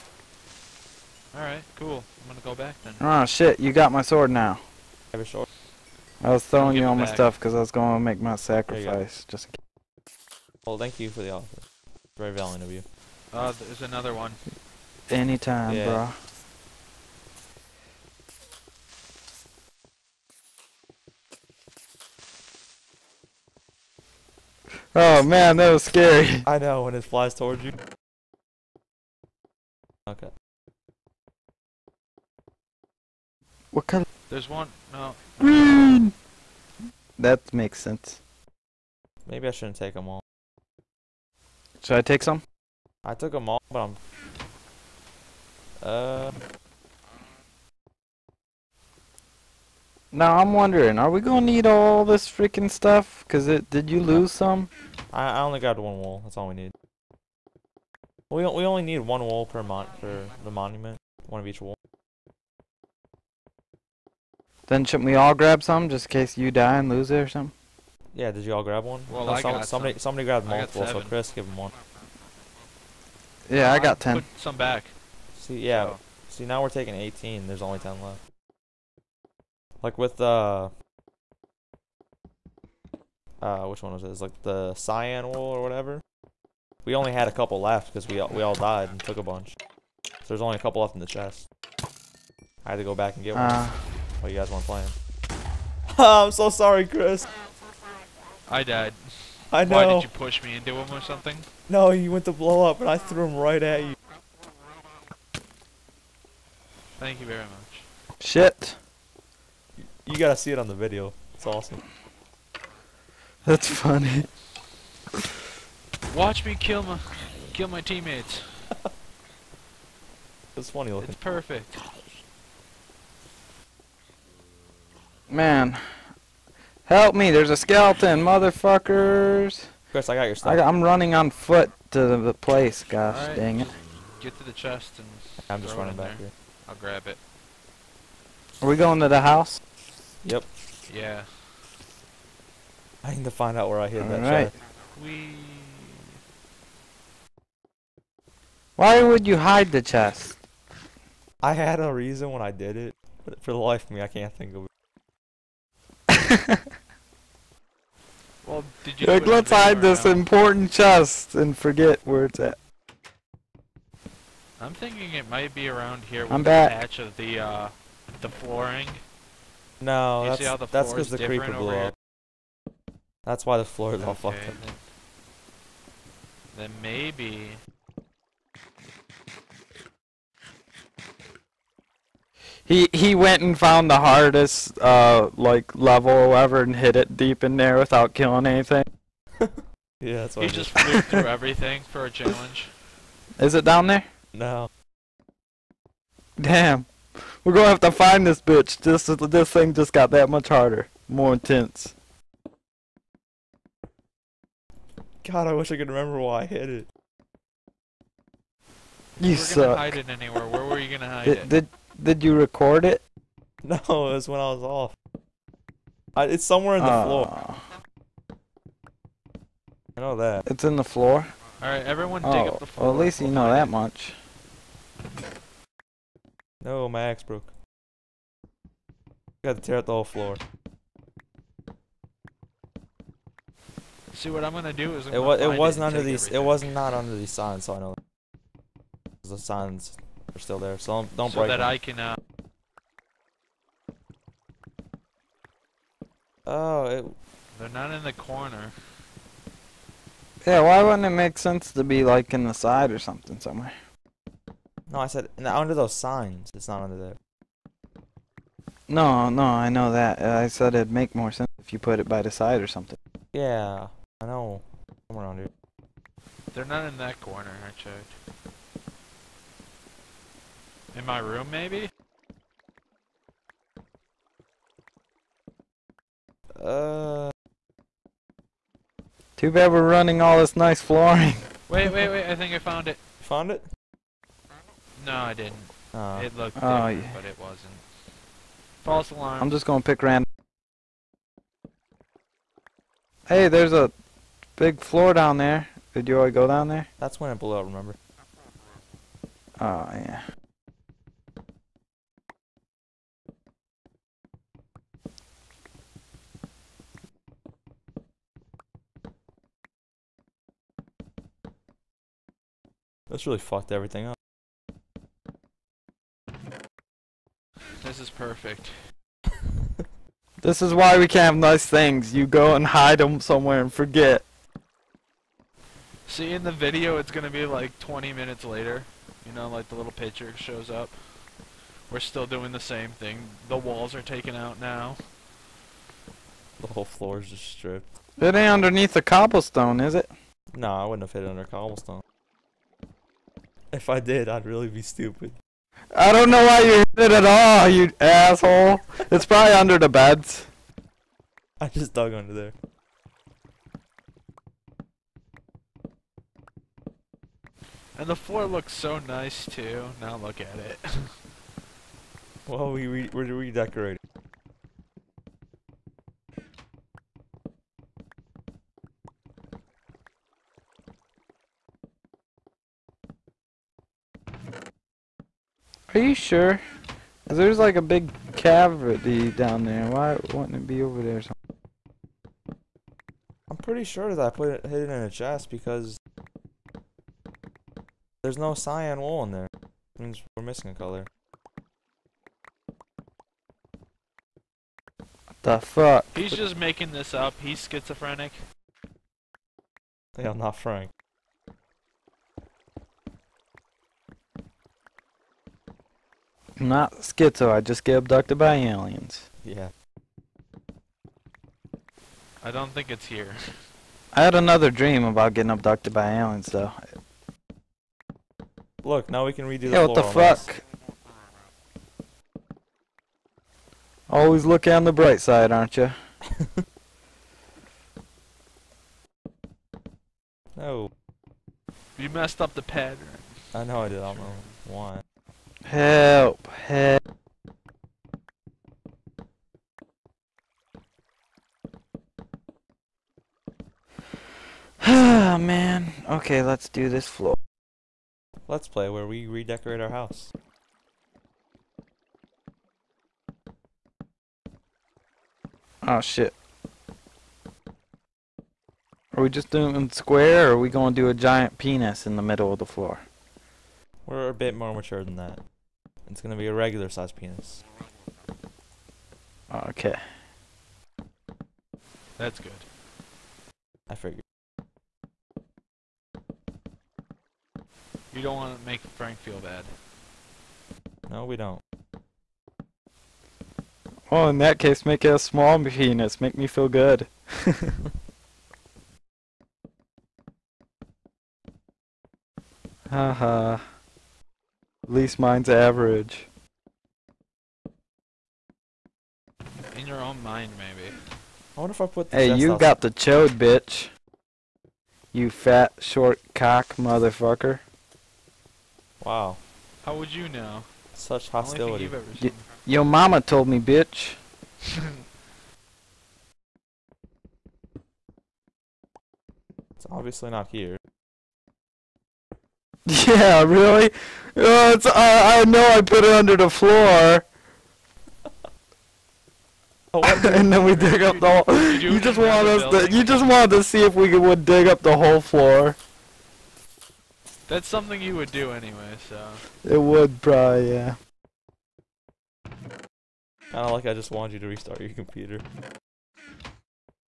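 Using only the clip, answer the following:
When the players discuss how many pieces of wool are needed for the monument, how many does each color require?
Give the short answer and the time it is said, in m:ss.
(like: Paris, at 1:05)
1, at 0:58.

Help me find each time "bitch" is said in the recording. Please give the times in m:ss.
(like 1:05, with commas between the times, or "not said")
3:18, 8:23, 8:33.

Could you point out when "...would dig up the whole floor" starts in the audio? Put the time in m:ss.
8:54.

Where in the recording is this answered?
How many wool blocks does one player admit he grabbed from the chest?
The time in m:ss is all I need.
1:13.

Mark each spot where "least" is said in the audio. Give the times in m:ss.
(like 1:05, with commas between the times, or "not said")
3:43, 8:14.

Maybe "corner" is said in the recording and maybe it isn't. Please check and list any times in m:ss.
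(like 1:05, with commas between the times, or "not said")
4:08, 4:27.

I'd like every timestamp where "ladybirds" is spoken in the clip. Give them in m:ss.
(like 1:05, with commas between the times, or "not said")
not said.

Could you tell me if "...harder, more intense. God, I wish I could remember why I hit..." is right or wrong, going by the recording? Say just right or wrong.
right.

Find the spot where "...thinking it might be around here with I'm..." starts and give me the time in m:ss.
2:44.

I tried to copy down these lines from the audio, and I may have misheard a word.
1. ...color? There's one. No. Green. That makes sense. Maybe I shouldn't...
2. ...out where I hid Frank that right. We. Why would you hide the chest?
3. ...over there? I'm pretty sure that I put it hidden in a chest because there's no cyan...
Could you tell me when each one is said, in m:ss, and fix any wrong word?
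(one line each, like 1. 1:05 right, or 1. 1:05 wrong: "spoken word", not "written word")
1. 0:33 right
2. 2:23 wrong: "All", not "Frank"
3. 6:20 right.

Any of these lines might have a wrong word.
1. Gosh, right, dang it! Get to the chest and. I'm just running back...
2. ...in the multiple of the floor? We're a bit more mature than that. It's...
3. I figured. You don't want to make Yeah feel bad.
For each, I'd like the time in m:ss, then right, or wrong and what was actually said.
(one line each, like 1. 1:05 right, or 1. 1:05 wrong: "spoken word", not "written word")
1. 2:12 right
2. 7:42 wrong: "middle", not "multiple"
3. 7:53 wrong: "Frank", not "Yeah".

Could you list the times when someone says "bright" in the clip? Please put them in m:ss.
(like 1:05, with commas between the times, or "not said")
7:04.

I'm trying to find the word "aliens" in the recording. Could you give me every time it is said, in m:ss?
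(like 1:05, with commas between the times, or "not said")
6:48, 6:56.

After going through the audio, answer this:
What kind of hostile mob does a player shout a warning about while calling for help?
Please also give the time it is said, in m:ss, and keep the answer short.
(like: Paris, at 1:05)
Skeleton, at 2:07.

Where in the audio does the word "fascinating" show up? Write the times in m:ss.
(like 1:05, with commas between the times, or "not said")
not said.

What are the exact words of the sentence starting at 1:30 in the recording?
So there's only a couple left in the chest.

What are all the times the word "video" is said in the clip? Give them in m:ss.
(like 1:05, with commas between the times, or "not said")
1:50, 5:26.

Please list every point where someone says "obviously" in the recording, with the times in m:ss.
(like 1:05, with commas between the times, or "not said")
8:39.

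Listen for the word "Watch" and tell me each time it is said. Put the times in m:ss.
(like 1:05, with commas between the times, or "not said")
1:56.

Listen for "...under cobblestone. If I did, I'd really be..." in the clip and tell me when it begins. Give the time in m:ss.
5:41.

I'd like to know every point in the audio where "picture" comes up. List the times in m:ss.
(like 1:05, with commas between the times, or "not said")
5:29.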